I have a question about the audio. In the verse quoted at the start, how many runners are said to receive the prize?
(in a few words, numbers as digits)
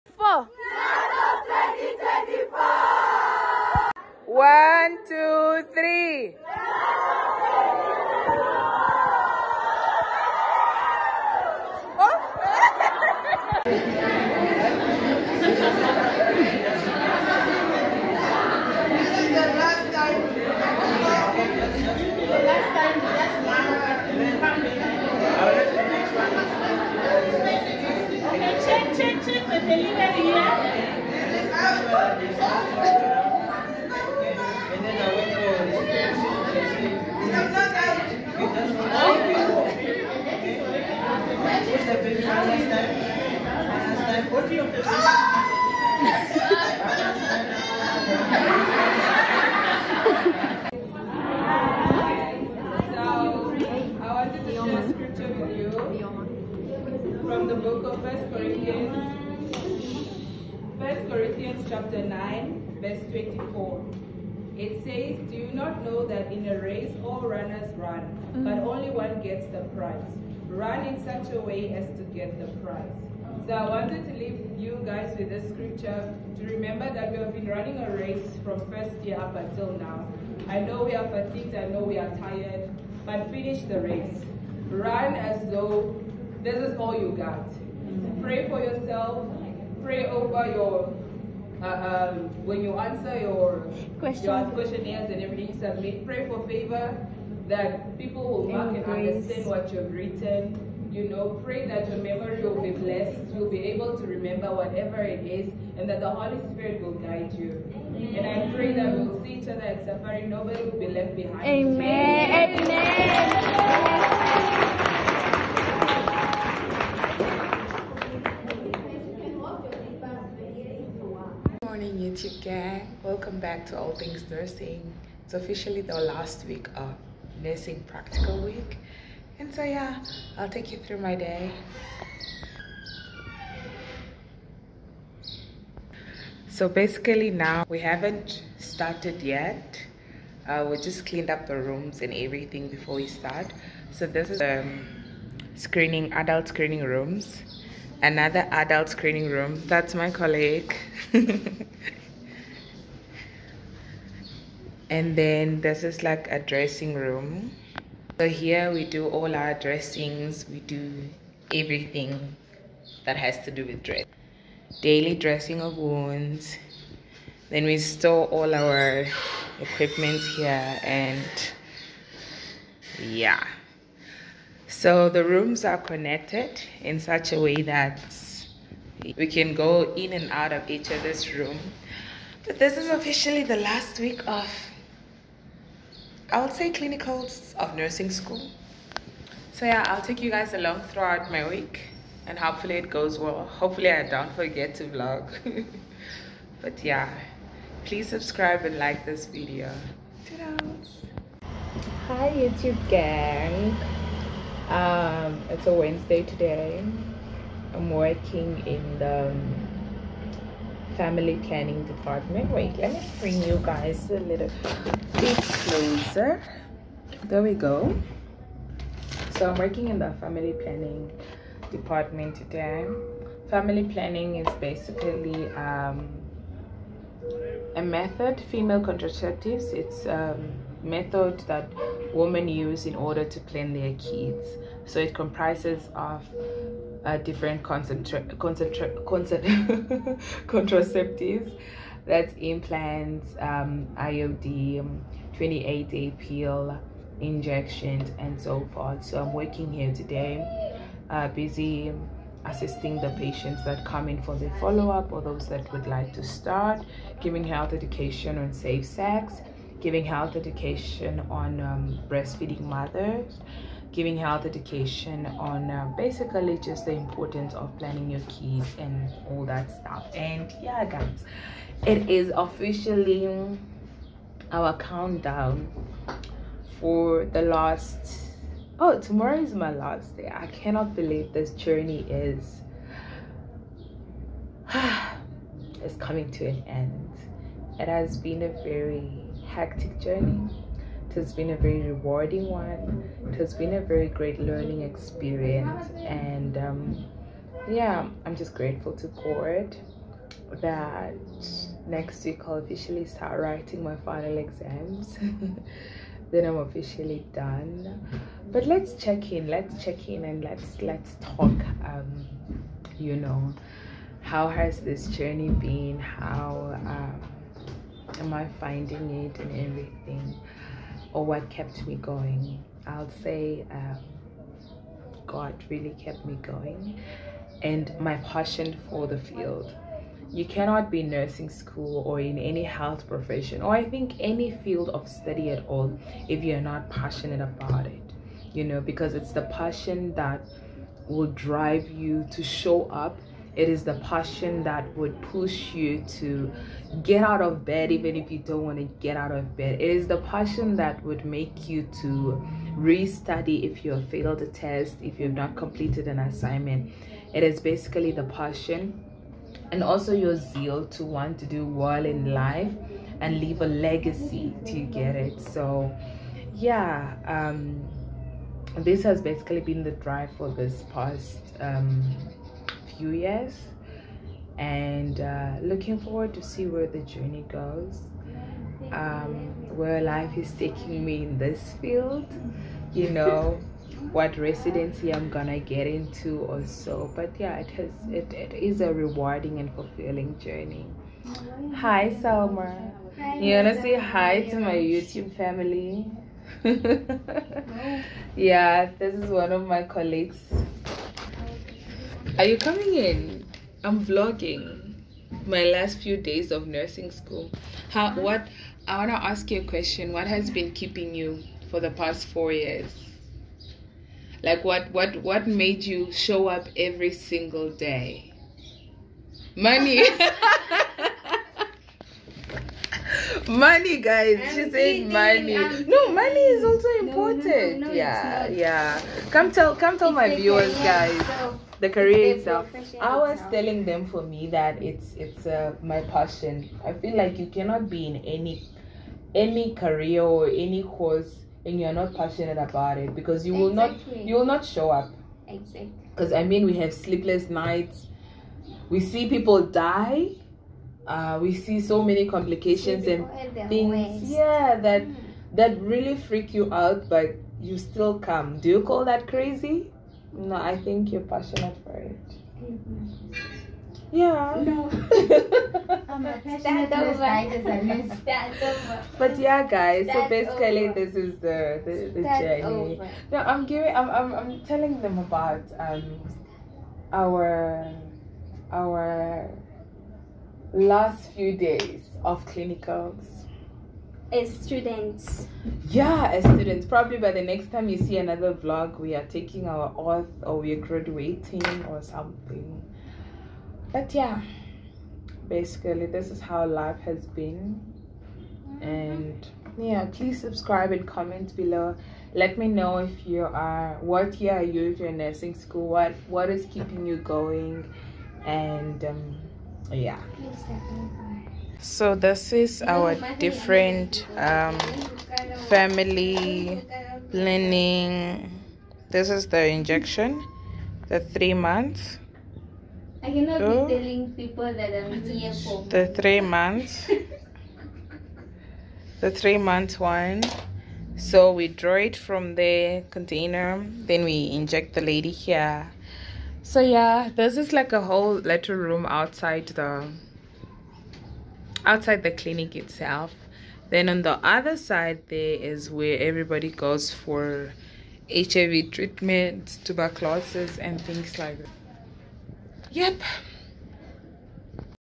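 1.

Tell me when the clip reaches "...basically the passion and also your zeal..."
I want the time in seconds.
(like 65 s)
357 s.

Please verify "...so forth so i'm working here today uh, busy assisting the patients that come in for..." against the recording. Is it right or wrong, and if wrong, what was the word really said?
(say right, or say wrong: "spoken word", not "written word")
right.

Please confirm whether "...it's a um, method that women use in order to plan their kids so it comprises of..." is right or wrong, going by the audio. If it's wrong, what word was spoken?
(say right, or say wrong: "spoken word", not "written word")
right.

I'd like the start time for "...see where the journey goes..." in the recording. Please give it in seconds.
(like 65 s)
376 s.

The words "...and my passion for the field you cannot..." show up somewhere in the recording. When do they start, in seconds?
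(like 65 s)
327 s.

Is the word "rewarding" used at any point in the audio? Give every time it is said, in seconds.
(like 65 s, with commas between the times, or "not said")
291 s, 388 s.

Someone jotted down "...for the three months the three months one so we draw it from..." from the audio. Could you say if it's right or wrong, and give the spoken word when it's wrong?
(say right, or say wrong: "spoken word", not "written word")
right.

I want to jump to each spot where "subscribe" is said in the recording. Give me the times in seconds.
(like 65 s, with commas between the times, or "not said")
198 s, 500 s.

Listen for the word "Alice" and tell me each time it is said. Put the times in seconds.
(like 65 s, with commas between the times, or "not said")
not said.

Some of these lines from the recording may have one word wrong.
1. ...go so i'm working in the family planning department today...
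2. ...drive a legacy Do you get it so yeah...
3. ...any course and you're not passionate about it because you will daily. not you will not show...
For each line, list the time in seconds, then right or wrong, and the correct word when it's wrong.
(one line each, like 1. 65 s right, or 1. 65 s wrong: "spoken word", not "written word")
1. 217 s right
2. 363 s wrong: "leave", not "drive"
3. 440 s wrong: "exactly", not "daily".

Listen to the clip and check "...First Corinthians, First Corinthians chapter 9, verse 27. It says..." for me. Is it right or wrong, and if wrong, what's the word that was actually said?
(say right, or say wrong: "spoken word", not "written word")
wrong: "24", not "27".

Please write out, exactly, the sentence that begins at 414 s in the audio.
Like what, what, what made you show up every single day?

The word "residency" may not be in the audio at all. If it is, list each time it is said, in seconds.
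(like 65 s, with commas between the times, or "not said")
384 s.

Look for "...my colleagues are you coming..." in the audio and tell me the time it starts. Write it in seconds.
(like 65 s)
399 s.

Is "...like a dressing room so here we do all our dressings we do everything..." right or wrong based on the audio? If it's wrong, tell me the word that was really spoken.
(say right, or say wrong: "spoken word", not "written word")
right.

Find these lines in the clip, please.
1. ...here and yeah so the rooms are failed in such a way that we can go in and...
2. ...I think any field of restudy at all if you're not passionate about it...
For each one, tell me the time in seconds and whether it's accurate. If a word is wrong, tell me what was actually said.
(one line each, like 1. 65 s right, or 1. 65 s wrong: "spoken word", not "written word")
1. 170 s wrong: "connected", not "failed"
2. 333 s wrong: "study", not "restudy".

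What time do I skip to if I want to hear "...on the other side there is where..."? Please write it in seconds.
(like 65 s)
544 s.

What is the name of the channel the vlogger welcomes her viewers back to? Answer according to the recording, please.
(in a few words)
All Things Nursing.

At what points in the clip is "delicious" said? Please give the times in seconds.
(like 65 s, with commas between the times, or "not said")
not said.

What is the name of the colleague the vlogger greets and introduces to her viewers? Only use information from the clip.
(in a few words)
Selma.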